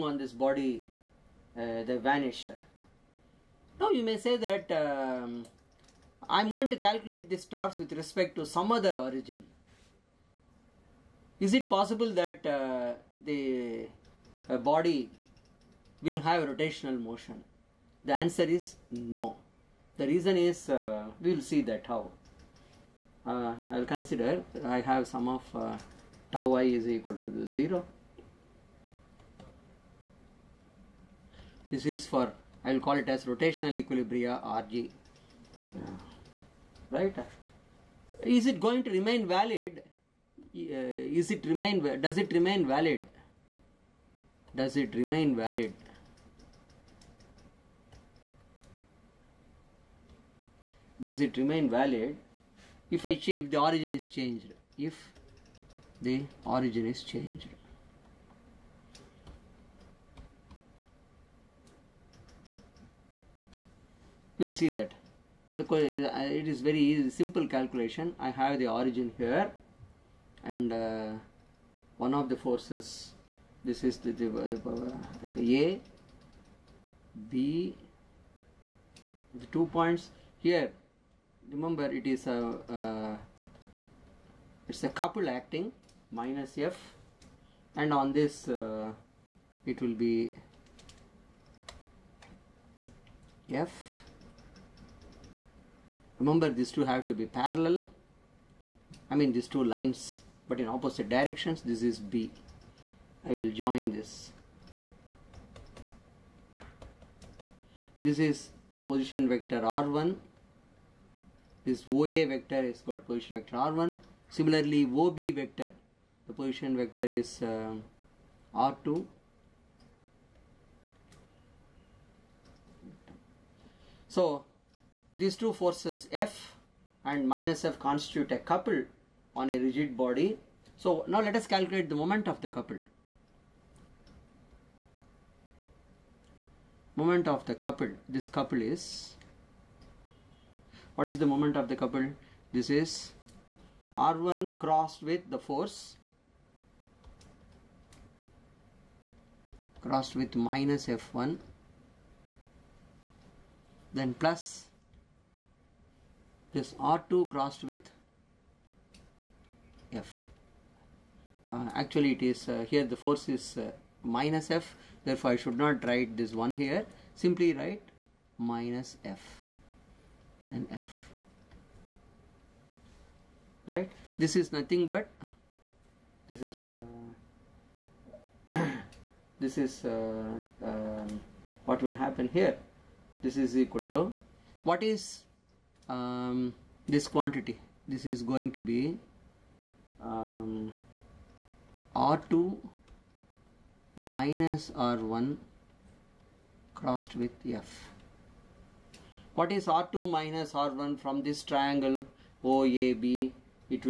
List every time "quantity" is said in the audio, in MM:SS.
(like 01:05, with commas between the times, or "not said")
03:07.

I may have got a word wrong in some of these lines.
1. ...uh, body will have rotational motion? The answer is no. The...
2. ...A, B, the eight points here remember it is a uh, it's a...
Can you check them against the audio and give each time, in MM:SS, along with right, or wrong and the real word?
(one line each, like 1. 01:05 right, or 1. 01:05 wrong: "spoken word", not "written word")
1. 00:14 right
2. 01:15 wrong: "two", not "eight".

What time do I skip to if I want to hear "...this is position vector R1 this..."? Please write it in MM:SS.
01:48.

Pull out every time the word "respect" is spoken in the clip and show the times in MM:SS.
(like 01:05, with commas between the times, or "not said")
00:07.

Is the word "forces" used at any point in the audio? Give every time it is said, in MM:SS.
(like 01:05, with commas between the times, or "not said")
01:12, 02:05, 02:25, 02:43.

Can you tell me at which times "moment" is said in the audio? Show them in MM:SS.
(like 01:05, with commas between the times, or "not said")
02:12, 02:16, 02:21.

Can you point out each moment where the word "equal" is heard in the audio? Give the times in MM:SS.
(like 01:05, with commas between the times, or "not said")
00:26, 03:03.